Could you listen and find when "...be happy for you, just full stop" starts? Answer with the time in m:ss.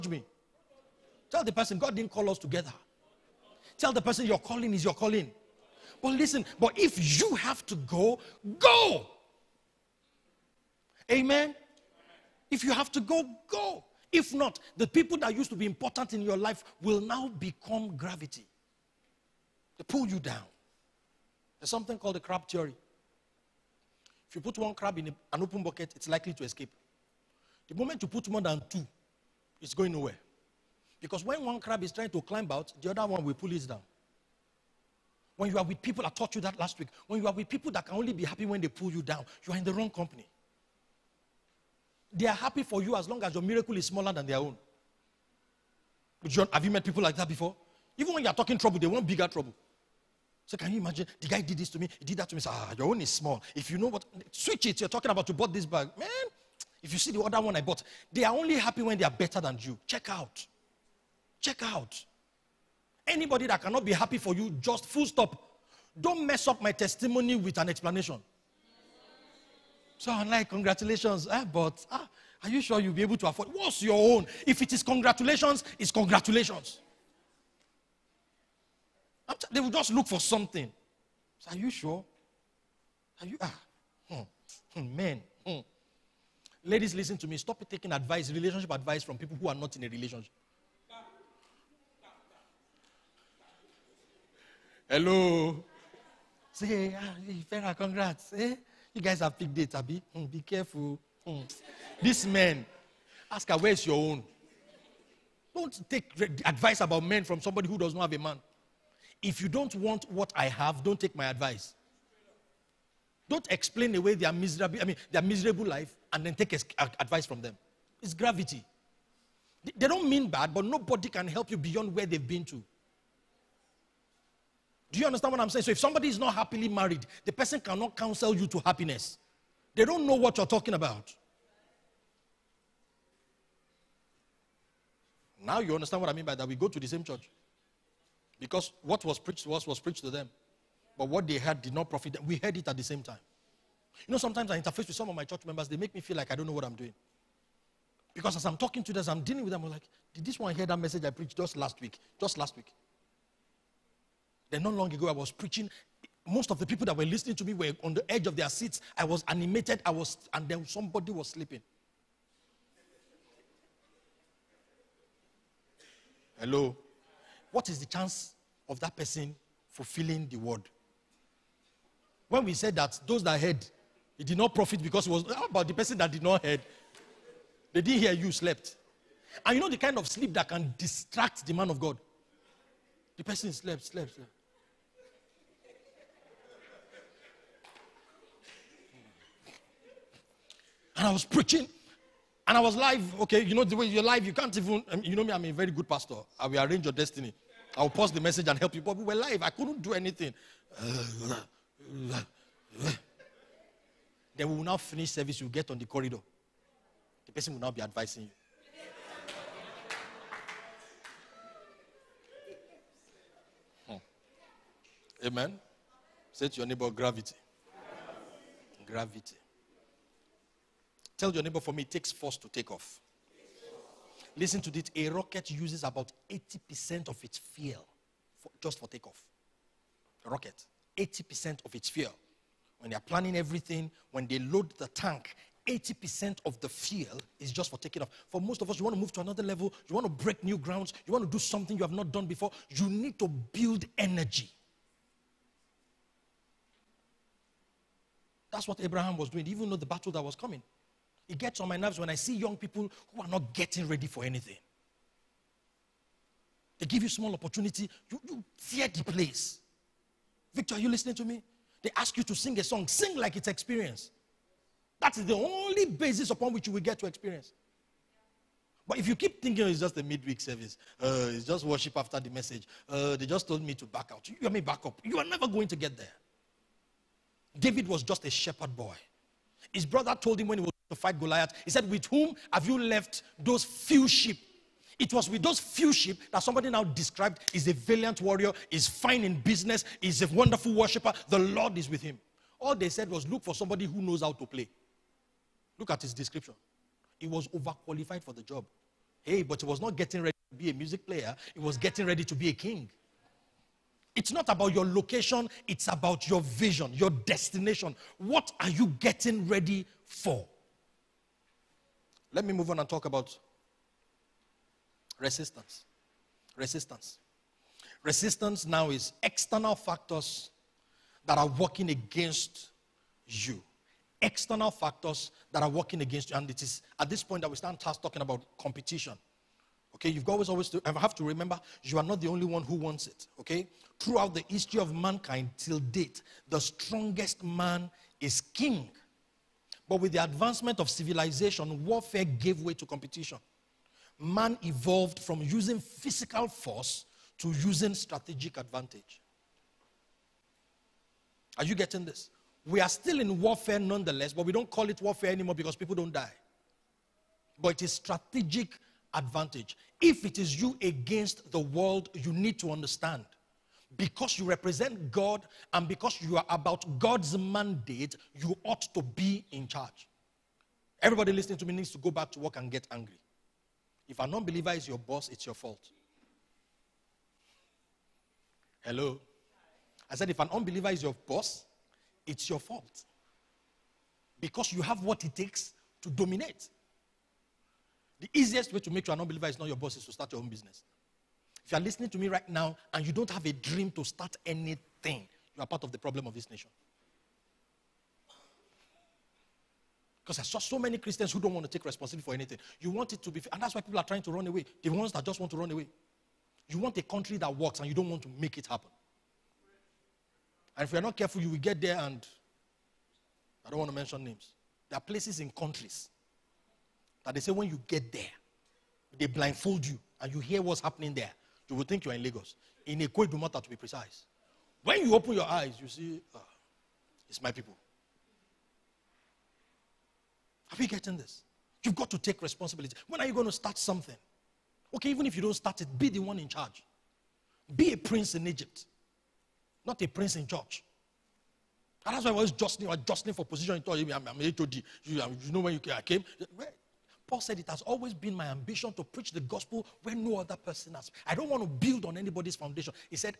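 1:03.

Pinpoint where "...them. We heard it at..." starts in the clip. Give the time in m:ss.
2:22.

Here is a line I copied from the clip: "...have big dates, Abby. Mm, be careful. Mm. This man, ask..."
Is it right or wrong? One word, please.
right.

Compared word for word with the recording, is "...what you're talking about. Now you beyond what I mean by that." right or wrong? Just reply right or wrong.
wrong.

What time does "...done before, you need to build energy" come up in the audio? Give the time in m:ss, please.
4:02.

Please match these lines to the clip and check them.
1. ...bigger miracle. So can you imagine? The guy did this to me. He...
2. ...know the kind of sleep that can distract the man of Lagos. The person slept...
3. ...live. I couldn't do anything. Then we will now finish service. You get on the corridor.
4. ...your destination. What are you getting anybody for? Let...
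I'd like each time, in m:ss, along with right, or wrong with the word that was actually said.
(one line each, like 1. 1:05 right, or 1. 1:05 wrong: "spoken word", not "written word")
1. 0:49 wrong: "trouble", not "miracle"
2. 2:59 wrong: "God", not "Lagos"
3. 3:19 right
4. 5:06 wrong: "ready", not "anybody".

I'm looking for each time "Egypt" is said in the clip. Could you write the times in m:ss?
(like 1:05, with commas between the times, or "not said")
7:18.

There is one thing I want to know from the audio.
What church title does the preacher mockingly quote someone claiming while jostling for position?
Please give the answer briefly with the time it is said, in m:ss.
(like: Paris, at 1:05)
HOD, at 7:24.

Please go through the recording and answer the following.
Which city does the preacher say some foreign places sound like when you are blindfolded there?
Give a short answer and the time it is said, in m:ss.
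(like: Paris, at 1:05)
Lagos, at 7:02.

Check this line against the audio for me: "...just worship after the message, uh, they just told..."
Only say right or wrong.
right.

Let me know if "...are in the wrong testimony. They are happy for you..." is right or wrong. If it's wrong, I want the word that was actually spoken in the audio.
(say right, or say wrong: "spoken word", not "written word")
wrong: "company", not "testimony".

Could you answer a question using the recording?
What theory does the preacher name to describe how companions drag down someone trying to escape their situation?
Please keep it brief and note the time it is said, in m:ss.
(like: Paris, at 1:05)
crab theory, at 0:22.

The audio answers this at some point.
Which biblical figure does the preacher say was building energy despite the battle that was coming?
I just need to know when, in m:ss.
4:08.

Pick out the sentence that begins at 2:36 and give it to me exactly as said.
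Most of the people that were listening to me were on the edge of their seats.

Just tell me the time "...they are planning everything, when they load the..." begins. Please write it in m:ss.
3:52.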